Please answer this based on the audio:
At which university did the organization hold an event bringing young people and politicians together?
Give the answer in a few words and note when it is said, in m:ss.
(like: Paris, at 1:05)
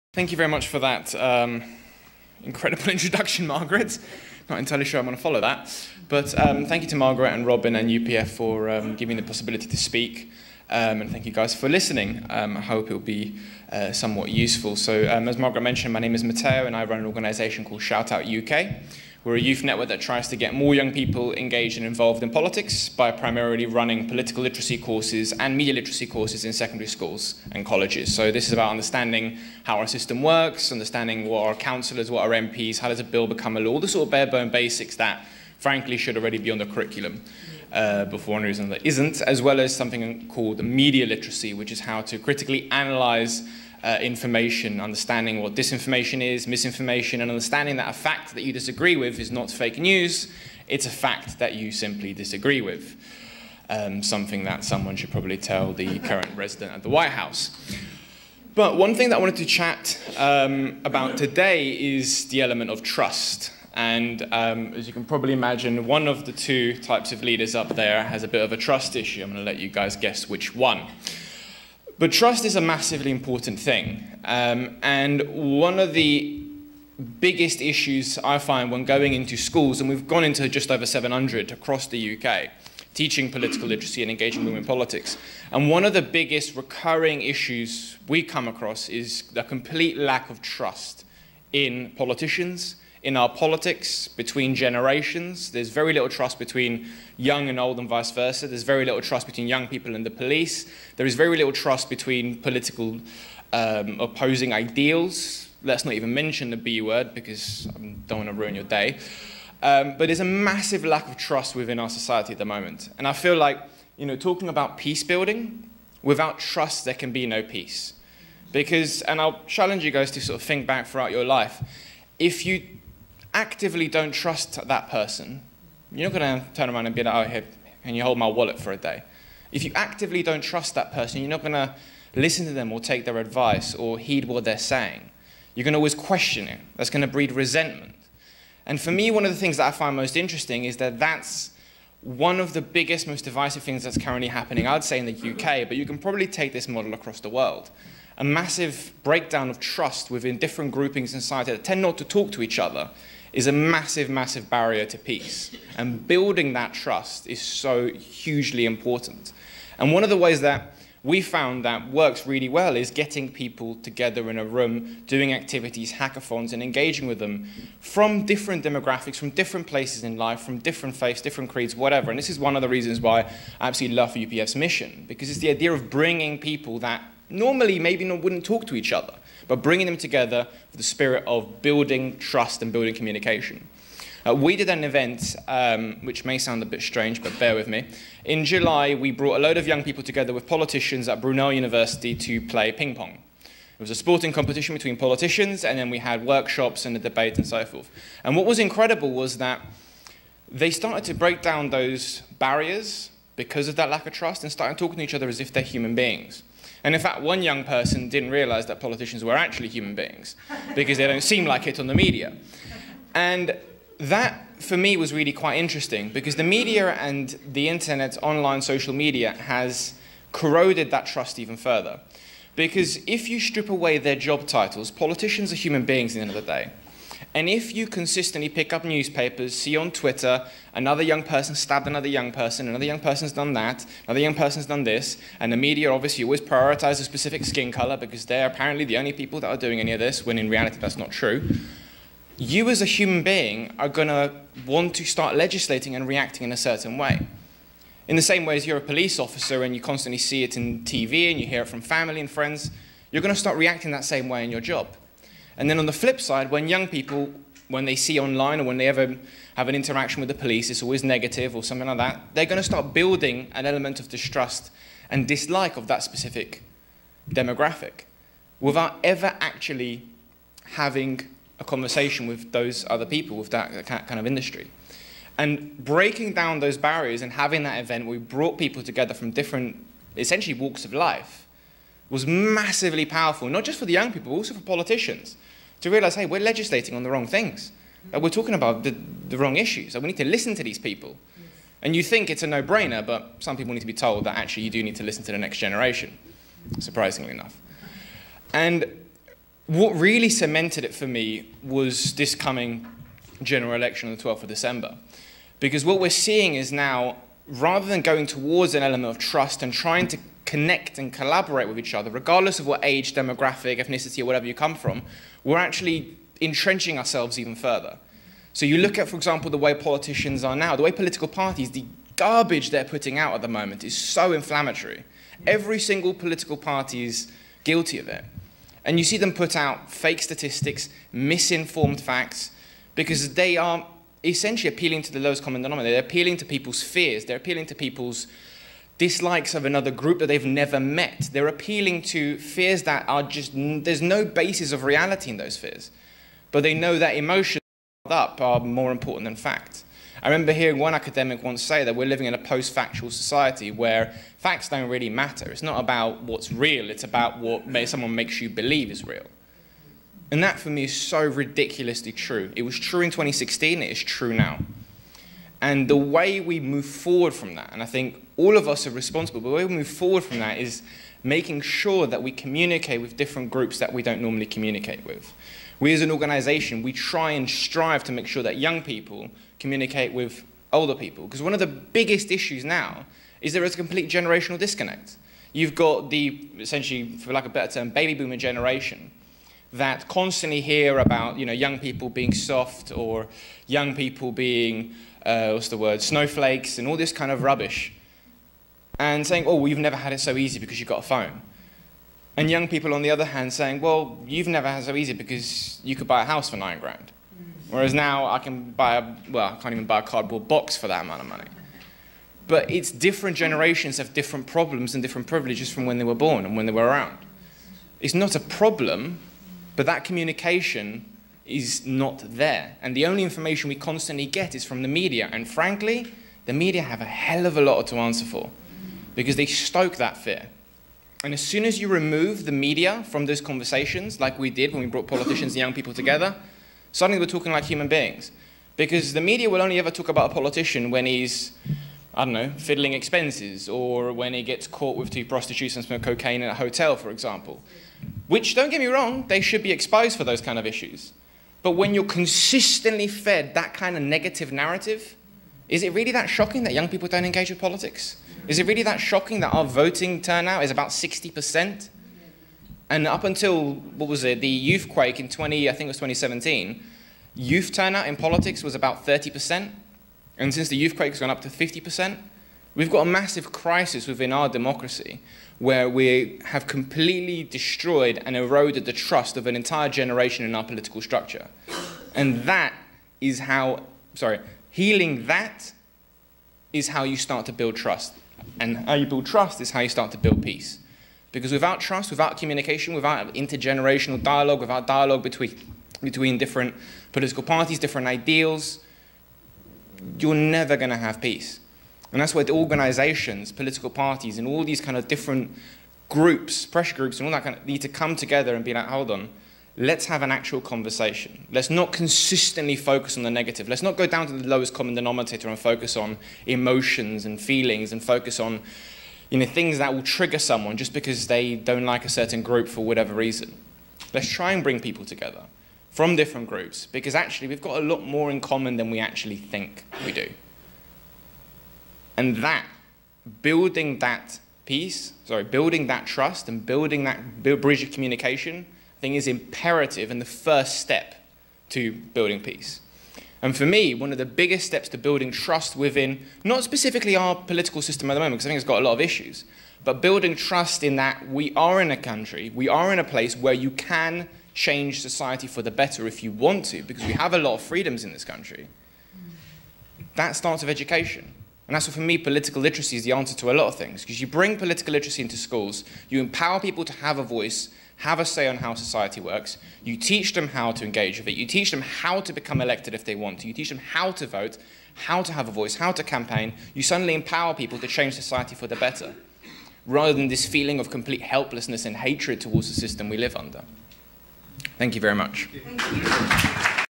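Brunel University, at 3:11.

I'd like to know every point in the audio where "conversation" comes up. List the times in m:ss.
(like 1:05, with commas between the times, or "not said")
4:31, 7:13, 8:30.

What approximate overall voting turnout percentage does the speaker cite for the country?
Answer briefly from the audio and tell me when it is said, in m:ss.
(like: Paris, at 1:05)
60%, at 7:40.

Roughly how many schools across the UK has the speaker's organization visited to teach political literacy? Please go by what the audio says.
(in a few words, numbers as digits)
700.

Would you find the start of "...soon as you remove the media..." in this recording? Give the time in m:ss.
7:11.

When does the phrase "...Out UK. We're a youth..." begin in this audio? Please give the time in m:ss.
0:18.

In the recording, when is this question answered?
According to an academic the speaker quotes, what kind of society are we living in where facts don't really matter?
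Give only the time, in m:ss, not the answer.
5:52.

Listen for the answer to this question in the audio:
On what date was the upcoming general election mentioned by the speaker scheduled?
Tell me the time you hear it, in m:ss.
5:04.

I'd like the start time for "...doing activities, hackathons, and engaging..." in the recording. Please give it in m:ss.
2:45.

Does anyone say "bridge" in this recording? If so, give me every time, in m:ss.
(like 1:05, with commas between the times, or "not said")
8:57.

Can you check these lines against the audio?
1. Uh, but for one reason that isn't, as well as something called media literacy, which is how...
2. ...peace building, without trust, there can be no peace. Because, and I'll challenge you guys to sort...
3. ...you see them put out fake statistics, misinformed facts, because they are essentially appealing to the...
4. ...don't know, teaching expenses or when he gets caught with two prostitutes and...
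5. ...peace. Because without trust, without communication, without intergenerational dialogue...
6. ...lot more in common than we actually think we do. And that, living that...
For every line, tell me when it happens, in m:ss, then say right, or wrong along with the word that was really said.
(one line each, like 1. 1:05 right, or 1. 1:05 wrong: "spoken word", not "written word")
1. 0:37 right
2. 1:54 right
3. 5:28 right
4. 7:22 wrong: "fiddling", not "teaching"
5. 8:10 right
6. 8:47 wrong: "building", not "living".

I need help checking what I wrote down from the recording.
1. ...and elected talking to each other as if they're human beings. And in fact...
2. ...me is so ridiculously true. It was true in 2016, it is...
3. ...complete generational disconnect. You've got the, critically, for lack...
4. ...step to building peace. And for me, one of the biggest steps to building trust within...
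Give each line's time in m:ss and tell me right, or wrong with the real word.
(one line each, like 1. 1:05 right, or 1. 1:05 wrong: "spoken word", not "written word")
1. 3:24 wrong: "started", not "elected"
2. 6:00 right
3. 6:23 wrong: "essentially", not "critically"
4. 9:00 right.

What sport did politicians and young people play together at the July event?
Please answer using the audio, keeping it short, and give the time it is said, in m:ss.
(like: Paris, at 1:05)
ping pong, at 3:12.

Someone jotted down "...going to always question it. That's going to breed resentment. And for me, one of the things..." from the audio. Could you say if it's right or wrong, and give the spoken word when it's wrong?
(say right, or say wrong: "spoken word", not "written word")
right.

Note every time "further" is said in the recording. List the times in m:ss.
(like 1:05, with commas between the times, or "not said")
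3:41, 5:17.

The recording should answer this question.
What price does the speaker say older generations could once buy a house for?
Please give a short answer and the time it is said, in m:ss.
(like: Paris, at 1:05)
nine grand, at 6:46.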